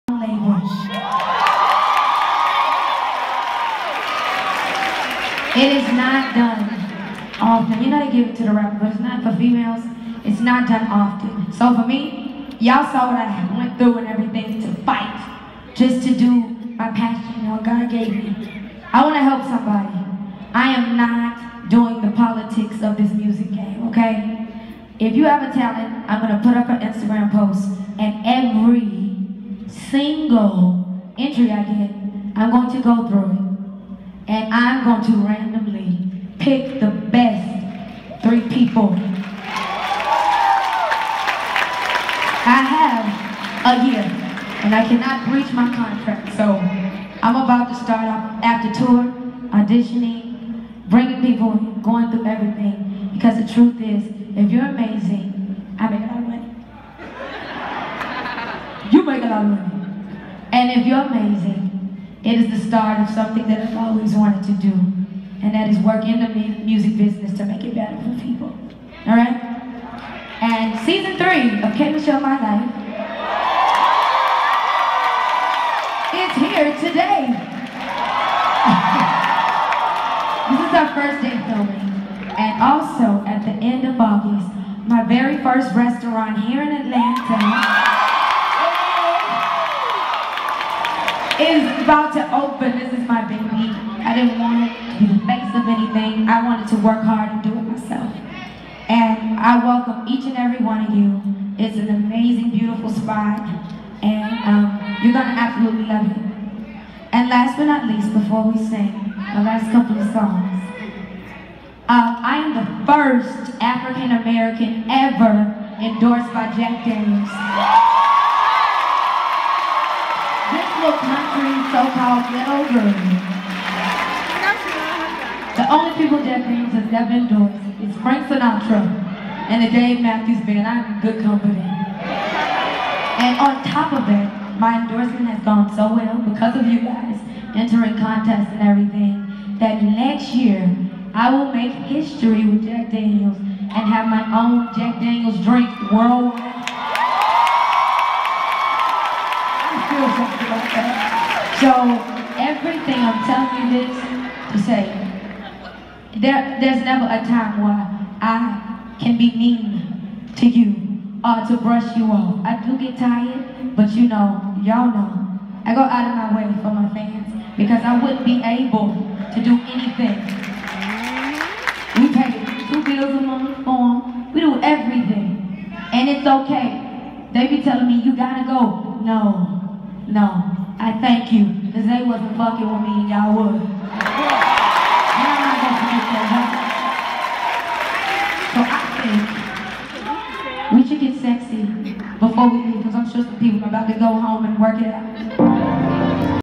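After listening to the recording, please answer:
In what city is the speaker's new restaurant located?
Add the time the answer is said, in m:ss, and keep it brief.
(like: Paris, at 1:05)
Atlanta, at 1:26.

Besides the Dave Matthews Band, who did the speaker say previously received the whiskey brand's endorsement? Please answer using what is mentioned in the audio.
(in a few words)
Frank Sinatra.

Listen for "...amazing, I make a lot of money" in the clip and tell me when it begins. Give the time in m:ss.
0:54.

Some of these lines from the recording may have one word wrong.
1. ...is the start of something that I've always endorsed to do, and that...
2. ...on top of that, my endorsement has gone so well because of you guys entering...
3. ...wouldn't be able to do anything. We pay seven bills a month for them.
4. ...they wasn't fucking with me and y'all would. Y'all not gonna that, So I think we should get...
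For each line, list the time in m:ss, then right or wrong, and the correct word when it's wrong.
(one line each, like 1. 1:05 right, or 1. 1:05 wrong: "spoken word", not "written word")
1. 1:02 wrong: "wanted", not "endorsed"
2. 2:13 right
3. 2:48 wrong: "two", not "seven"
4. 3:01 right.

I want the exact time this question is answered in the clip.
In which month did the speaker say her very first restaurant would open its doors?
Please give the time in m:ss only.
1:23.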